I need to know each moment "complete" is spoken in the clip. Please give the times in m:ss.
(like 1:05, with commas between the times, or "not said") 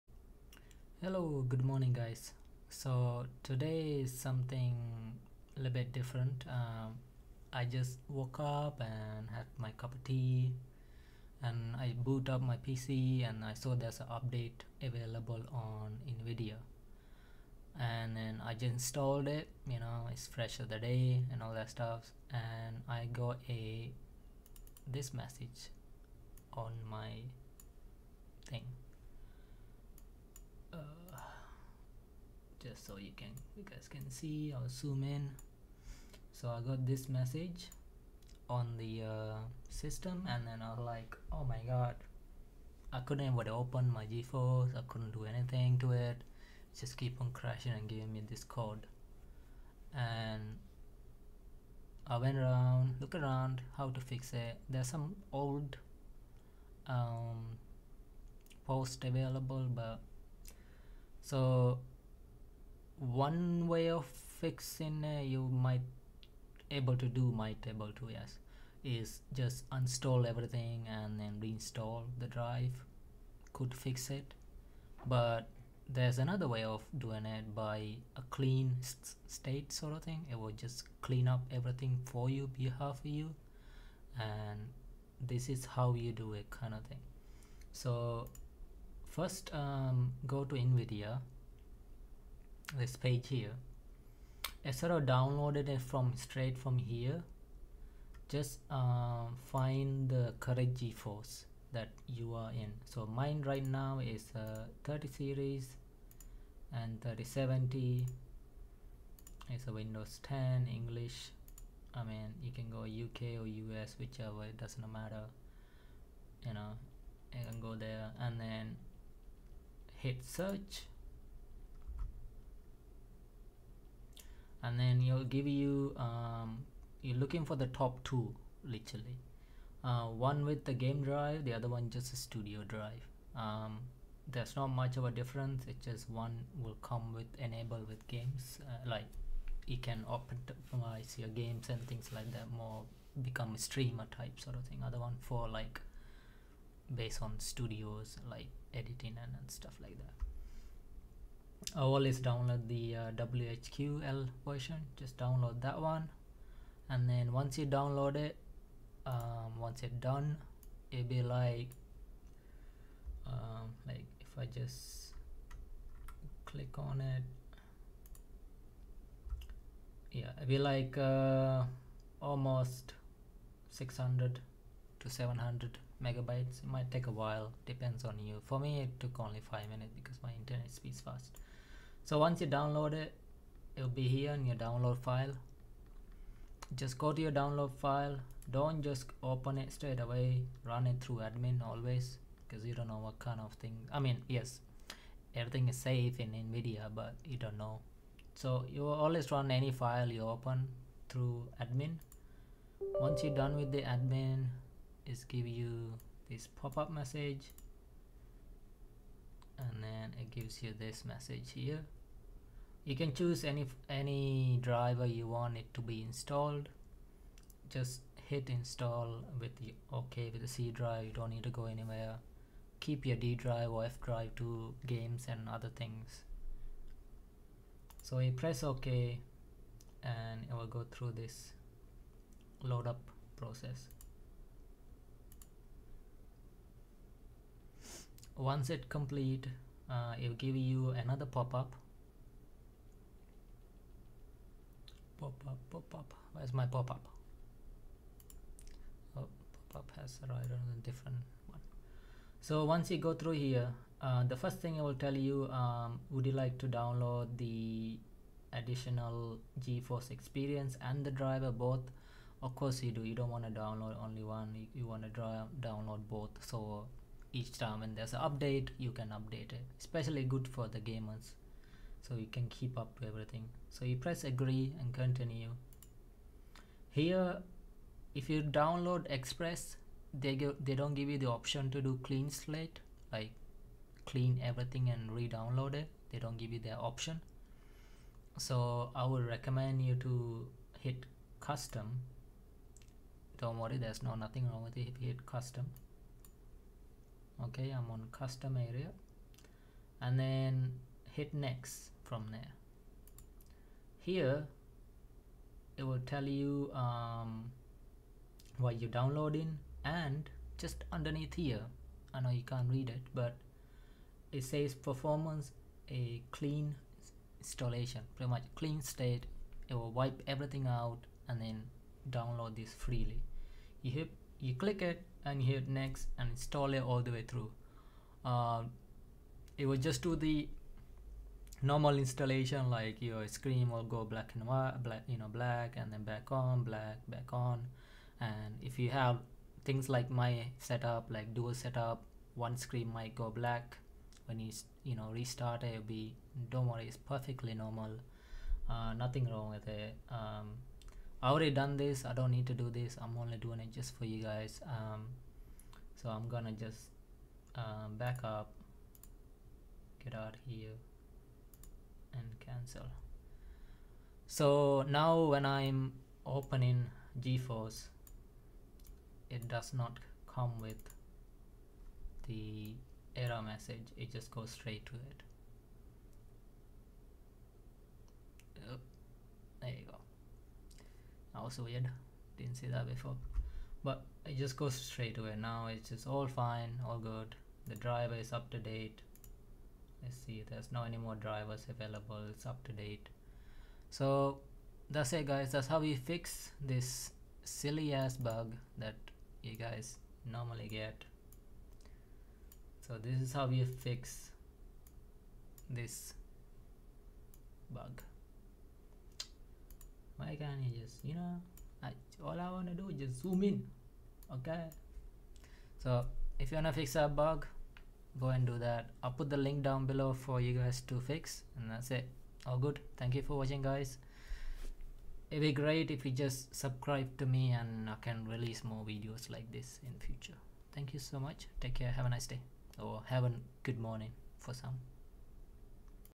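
3:58.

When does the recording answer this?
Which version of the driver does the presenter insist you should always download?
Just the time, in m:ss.
2:33.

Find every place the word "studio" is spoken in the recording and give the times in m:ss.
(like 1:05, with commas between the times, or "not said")
2:12, 2:27.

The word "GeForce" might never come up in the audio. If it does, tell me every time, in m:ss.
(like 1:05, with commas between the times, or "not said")
0:44, 1:40, 4:19, 6:07.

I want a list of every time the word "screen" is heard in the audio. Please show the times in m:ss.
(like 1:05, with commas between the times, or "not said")
5:33, 5:42.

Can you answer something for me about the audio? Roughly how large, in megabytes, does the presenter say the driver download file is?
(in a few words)
600 to 700 megabytes.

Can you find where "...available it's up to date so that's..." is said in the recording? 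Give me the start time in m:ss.
6:31.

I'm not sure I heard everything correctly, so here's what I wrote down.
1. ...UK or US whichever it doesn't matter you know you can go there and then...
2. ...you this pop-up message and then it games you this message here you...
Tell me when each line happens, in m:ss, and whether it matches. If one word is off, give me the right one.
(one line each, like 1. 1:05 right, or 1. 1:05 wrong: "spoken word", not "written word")
1. 1:52 right
2. 3:25 wrong: "gives", not "games".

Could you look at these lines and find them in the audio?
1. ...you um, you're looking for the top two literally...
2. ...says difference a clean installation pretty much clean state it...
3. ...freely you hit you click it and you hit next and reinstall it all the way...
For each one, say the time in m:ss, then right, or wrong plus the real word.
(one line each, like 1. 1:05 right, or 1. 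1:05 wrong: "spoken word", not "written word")
1. 2:05 right
2. 5:14 wrong: "performance", not "difference"
3. 5:22 wrong: "install", not "reinstall".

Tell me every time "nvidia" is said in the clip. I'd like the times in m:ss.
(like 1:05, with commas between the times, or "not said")
0:16, 1:30, 3:16.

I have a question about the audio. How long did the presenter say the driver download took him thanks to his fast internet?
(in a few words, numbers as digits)
5 minutes.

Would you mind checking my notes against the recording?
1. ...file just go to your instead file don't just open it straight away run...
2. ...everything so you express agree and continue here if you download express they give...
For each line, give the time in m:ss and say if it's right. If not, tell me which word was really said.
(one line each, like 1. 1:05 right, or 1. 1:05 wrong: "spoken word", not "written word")
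1. 3:04 wrong: "download", not "instead"
2. 4:33 wrong: "press", not "express".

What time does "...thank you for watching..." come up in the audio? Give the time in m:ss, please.
7:02.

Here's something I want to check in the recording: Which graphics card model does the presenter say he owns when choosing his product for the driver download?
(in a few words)
3070.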